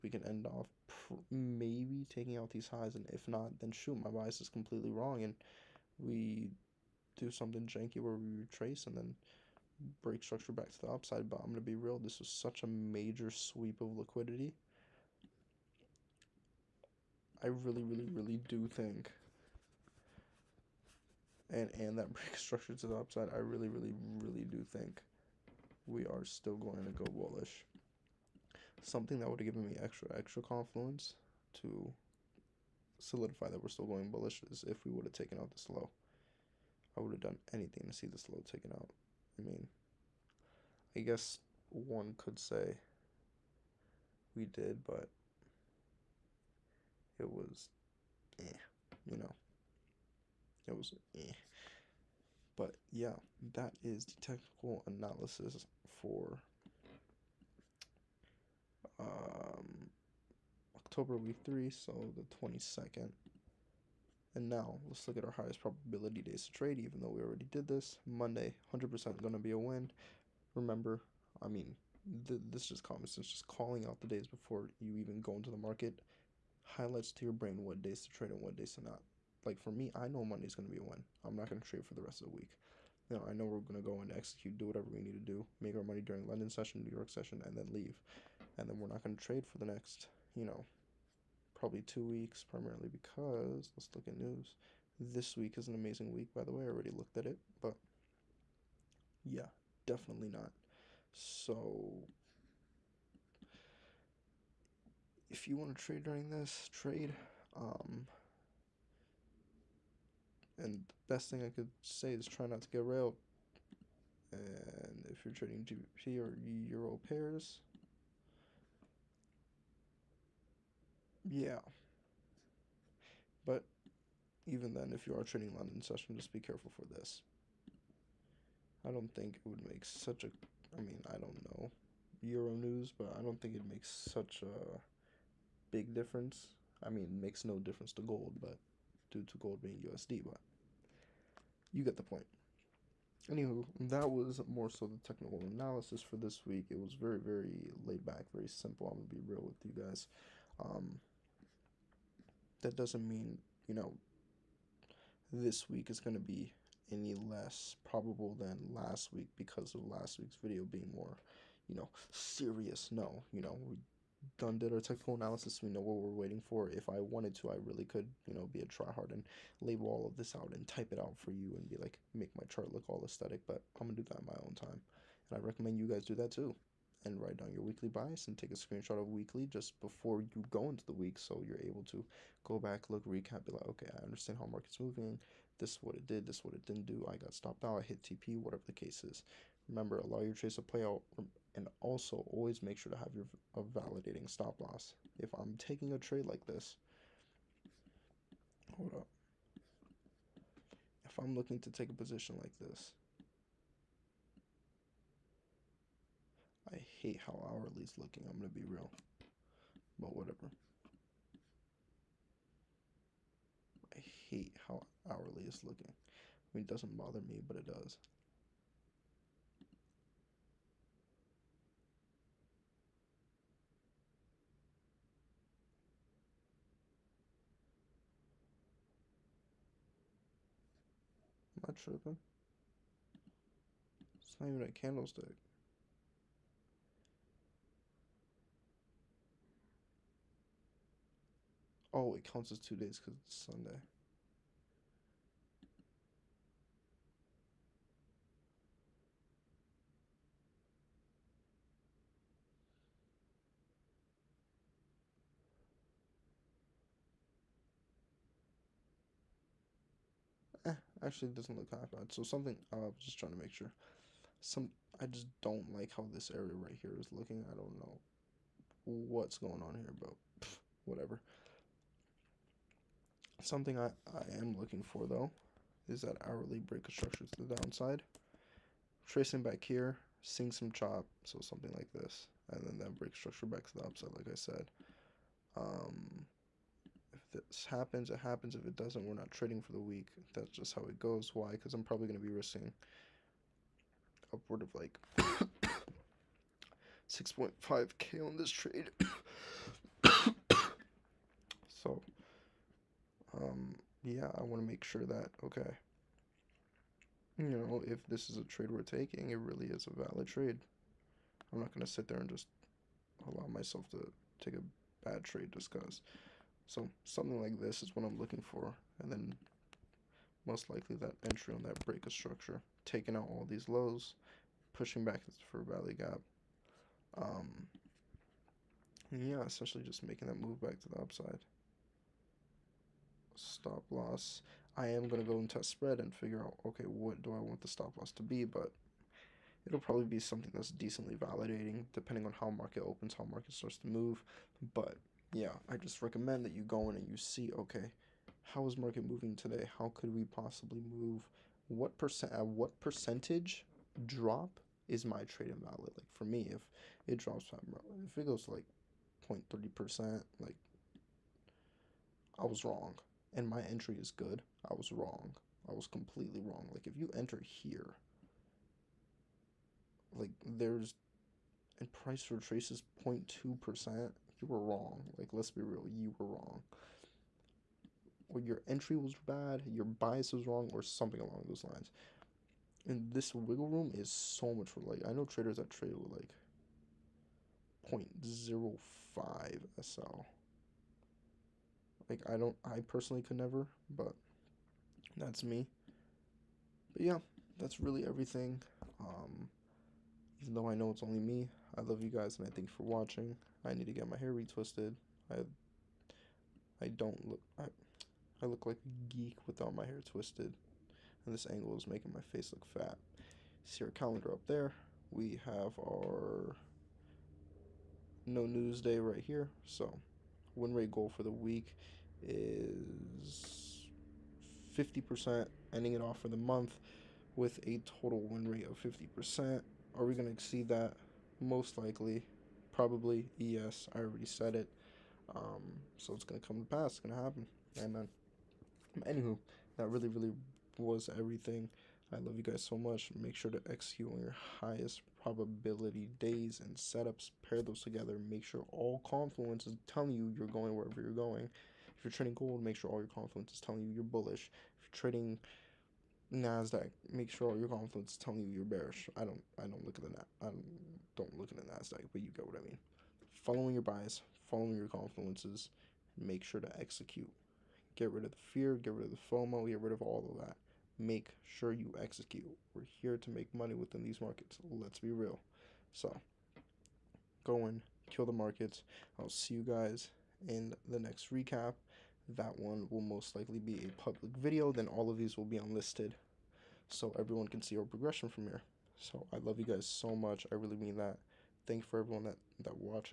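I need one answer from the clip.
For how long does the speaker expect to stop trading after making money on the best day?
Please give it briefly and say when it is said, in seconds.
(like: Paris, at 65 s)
two weeks, at 91 s.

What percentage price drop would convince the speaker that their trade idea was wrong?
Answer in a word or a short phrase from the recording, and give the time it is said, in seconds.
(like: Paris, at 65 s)
0.3%, at 359 s.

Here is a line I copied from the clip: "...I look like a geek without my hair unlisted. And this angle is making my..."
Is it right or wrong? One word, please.
wrong.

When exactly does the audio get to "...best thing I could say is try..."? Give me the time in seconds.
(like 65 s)
111 s.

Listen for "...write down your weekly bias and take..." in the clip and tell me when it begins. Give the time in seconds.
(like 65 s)
177 s.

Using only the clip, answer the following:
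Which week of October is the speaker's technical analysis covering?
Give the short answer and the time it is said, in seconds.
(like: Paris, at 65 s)
Week 3, at 60 s.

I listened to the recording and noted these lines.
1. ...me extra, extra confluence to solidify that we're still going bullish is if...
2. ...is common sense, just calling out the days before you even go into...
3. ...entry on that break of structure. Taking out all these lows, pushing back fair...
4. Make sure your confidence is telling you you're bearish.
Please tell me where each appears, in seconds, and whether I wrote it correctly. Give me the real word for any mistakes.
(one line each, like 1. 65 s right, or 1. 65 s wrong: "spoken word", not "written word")
1. 29 s right
2. 72 s right
3. 321 s right
4. 457 s right.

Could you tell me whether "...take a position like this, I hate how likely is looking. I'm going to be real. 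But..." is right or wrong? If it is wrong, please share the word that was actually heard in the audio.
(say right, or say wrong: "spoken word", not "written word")
wrong: "hourly", not "likely".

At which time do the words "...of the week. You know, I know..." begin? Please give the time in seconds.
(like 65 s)
82 s.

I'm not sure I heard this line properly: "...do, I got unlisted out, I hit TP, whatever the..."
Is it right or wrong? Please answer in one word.
wrong.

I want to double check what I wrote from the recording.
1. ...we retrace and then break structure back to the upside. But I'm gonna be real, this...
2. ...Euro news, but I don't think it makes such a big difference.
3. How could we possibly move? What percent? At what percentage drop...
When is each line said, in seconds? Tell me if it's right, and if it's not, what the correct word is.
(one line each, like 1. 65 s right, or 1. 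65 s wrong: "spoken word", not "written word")
1. 8 s right
2. 132 s right
3. 349 s right.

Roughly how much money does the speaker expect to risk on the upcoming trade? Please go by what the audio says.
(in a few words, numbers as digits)
6.5k.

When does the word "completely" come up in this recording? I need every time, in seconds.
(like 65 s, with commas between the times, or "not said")
4 s, 365 s.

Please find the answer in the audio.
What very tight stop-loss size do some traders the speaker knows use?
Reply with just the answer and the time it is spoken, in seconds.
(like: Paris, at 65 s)
0.05, at 388 s.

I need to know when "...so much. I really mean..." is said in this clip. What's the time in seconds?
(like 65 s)
489 s.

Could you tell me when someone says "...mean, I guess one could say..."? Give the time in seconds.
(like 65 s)
39 s.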